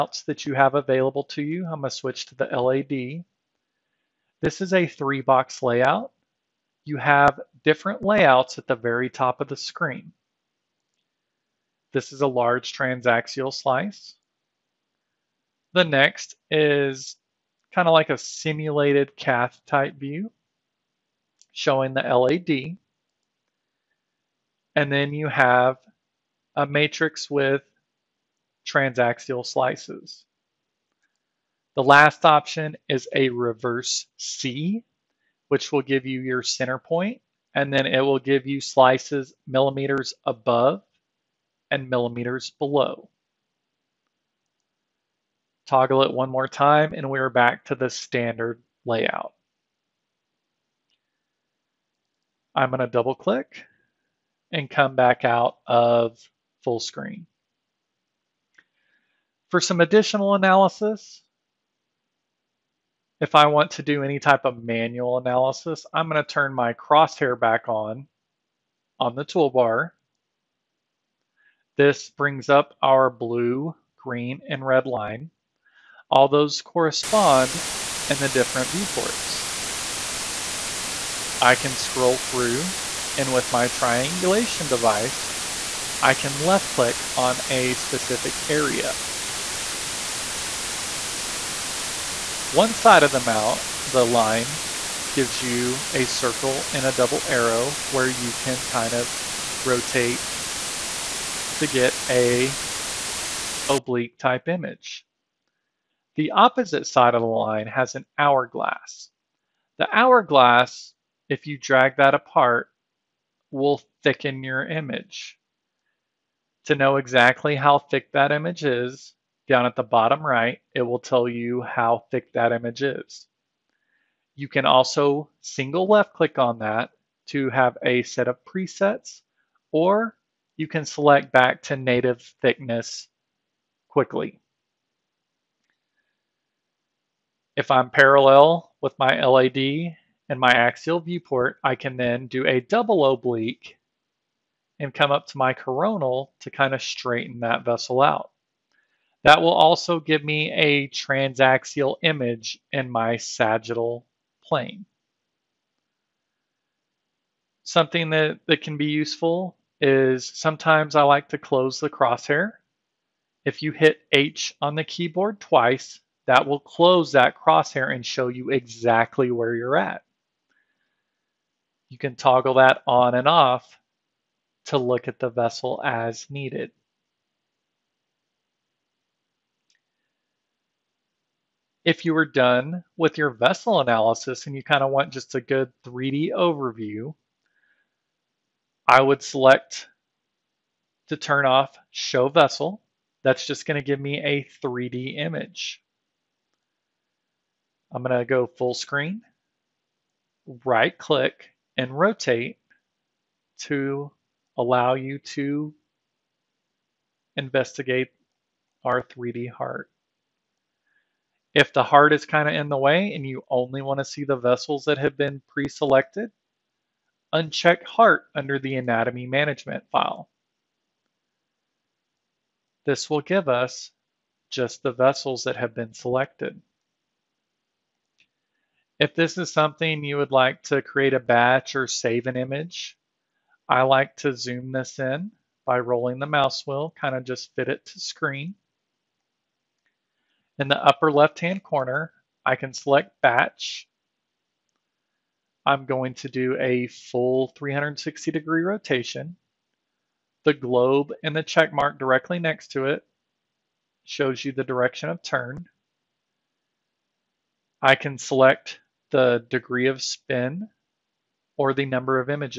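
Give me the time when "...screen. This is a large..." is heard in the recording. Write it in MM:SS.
00:09.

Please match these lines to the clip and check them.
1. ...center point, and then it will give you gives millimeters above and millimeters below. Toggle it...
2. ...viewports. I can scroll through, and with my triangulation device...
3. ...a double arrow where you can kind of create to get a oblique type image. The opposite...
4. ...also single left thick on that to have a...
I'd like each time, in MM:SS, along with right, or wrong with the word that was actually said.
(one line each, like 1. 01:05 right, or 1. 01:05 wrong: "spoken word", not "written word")
1. 00:36 wrong: "slices", not "gives"
2. 01:18 right
3. 01:36 wrong: "rotate", not "create"
4. 02:04 wrong: "click", not "thick".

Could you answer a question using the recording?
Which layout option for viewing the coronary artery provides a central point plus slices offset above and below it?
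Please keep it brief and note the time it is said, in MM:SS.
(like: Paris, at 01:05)
Reverse C, at 00:33.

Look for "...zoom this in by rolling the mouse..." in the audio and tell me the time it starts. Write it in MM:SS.
03:54.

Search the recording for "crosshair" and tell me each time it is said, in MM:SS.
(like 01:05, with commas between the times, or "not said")
01:06, 02:41, 02:47.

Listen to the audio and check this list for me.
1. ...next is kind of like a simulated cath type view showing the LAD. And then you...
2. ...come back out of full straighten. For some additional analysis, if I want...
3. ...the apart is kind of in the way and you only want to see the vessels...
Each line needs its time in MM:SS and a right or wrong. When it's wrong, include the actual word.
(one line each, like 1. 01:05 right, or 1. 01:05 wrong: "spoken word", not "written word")
1. 00:15 right
2. 00:54 wrong: "screen", not "straighten"
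3. 03:31 wrong: "heart", not "apart".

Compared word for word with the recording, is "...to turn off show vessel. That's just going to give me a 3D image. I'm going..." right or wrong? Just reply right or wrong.
right.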